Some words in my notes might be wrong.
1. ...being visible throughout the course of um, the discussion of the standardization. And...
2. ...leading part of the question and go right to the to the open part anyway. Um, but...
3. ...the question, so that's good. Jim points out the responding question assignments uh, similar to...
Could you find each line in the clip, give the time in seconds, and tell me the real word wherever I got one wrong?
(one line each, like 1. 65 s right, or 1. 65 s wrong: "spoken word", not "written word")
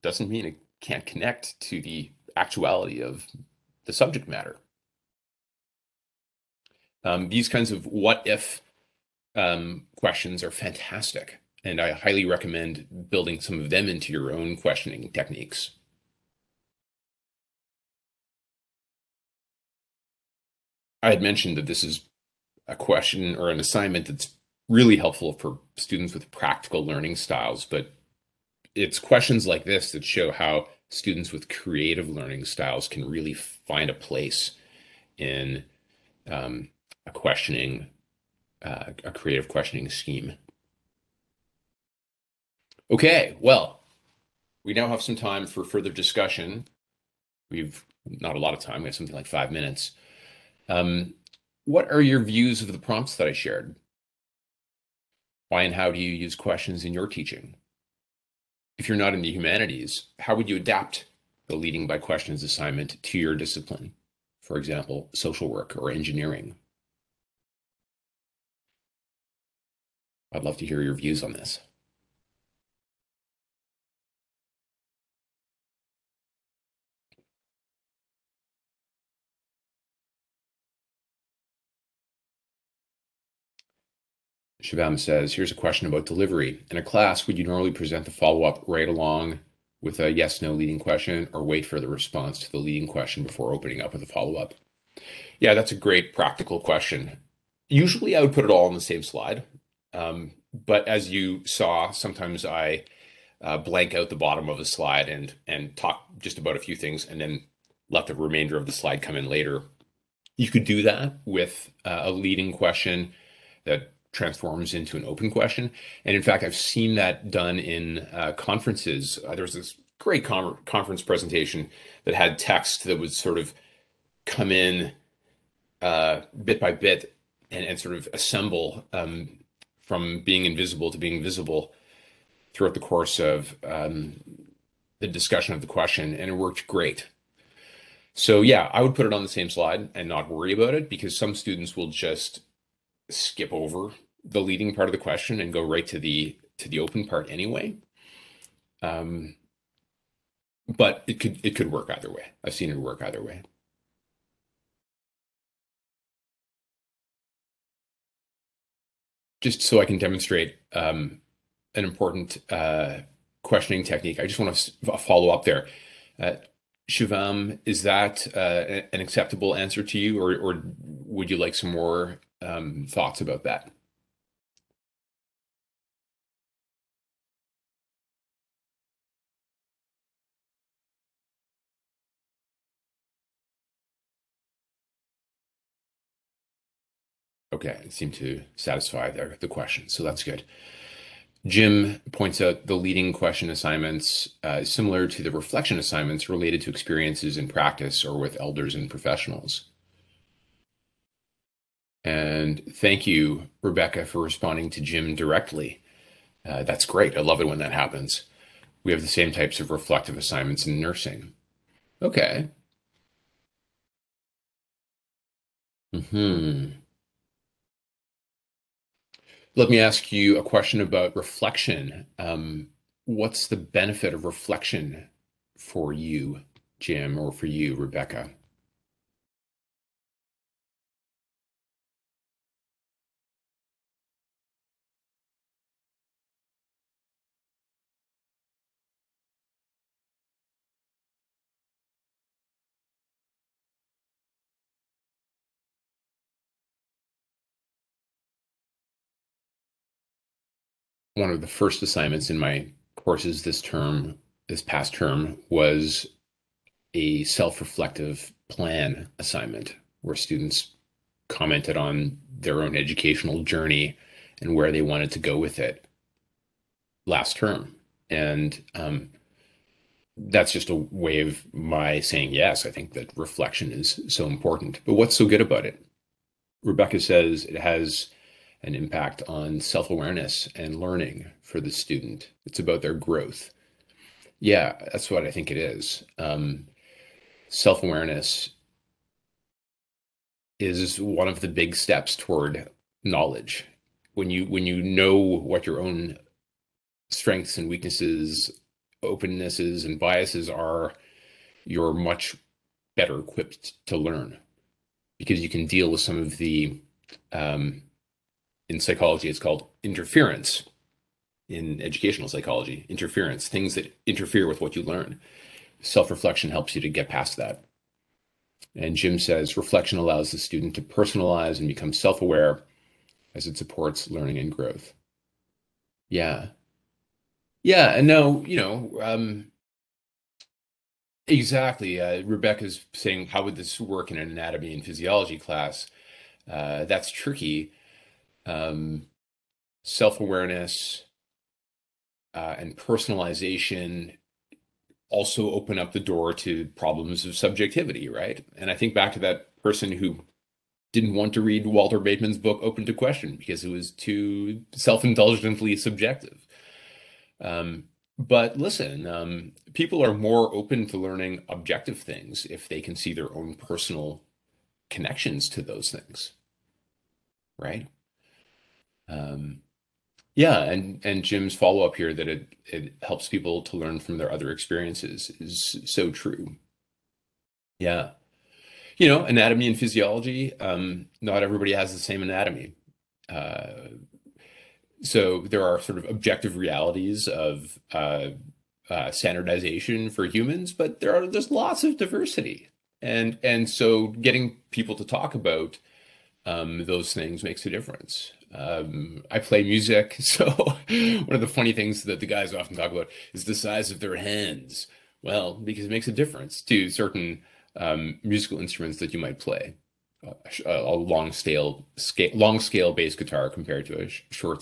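1. 130 s wrong: "question", not "standardization"
2. 144 s right
3. 189 s wrong: "leading", not "responding".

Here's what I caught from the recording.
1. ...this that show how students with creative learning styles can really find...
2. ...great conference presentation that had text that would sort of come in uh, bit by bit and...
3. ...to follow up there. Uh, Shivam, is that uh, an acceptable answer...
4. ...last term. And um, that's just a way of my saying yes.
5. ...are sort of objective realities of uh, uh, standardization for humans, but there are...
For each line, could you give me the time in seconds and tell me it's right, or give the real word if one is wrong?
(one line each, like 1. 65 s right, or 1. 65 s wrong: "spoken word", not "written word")
1. 29 s right
2. 119 s right
3. 164 s right
4. 267 s right
5. 385 s right.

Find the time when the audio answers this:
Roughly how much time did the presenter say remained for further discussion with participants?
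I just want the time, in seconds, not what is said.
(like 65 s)
49 s.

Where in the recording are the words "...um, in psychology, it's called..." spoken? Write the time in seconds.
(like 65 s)
307 s.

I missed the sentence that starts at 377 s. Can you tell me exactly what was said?
Yeah, you know, anatomy and physiology.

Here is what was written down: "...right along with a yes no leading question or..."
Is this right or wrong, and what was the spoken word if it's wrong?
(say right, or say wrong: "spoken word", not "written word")
right.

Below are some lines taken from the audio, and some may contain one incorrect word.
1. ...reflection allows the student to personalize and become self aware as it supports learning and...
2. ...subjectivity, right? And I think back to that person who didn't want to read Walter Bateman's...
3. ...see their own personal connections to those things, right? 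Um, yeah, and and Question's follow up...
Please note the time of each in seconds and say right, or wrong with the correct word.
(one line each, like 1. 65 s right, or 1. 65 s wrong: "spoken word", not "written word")
1. 319 s right
2. 347 s right
3. 362 s wrong: "Jim", not "Question".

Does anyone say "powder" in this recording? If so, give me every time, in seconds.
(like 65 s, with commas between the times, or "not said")
not said.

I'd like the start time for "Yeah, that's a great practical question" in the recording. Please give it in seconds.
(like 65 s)
95 s.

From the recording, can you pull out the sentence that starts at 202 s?
And thank you, Rebecca, for responding to Jim directly.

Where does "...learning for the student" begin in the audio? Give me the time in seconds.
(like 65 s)
280 s.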